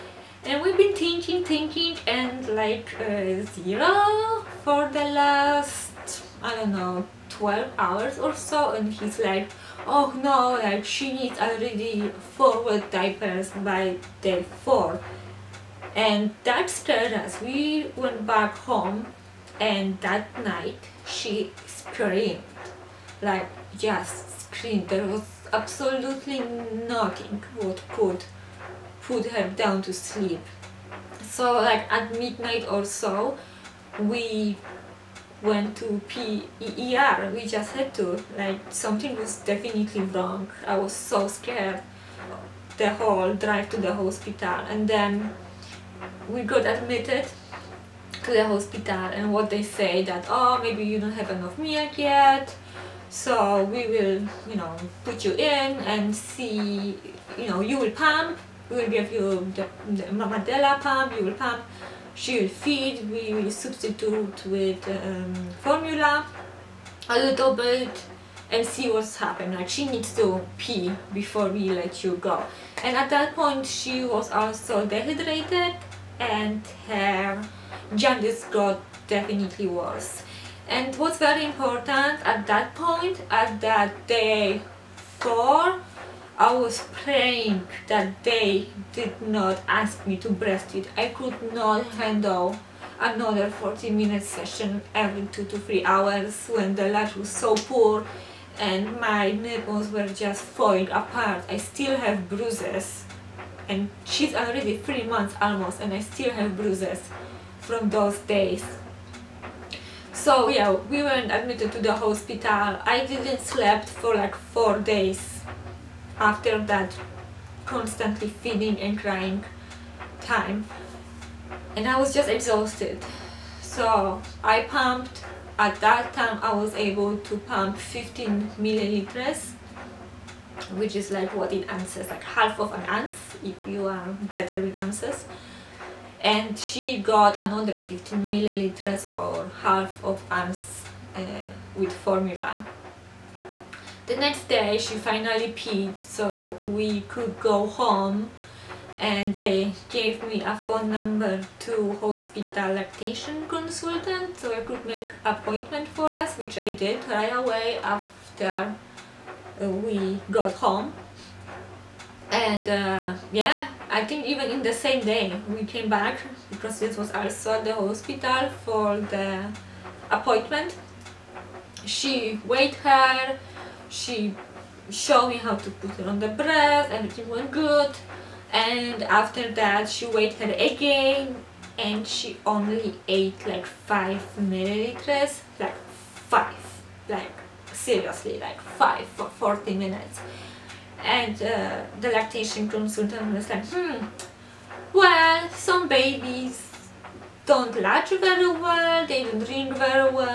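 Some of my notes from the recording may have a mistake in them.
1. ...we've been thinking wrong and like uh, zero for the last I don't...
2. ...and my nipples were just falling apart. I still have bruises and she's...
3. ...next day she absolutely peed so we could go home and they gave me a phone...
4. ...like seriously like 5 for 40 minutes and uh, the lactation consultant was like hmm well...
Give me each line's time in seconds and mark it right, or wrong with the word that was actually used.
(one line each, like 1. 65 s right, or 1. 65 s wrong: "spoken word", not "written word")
1. 0 s wrong: "thinking", not "wrong"
2. 98 s right
3. 144 s wrong: "finally", not "absolutely"
4. 187 s right.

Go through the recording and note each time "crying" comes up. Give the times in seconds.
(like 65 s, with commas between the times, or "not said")
118 s.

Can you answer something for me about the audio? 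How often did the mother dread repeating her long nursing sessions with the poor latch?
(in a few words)
Every 2 to 3 hours.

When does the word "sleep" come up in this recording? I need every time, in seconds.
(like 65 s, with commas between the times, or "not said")
29 s, 113 s.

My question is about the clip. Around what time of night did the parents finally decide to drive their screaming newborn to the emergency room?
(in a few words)
Midnight.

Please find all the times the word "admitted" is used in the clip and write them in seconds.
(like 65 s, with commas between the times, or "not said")
46 s, 111 s.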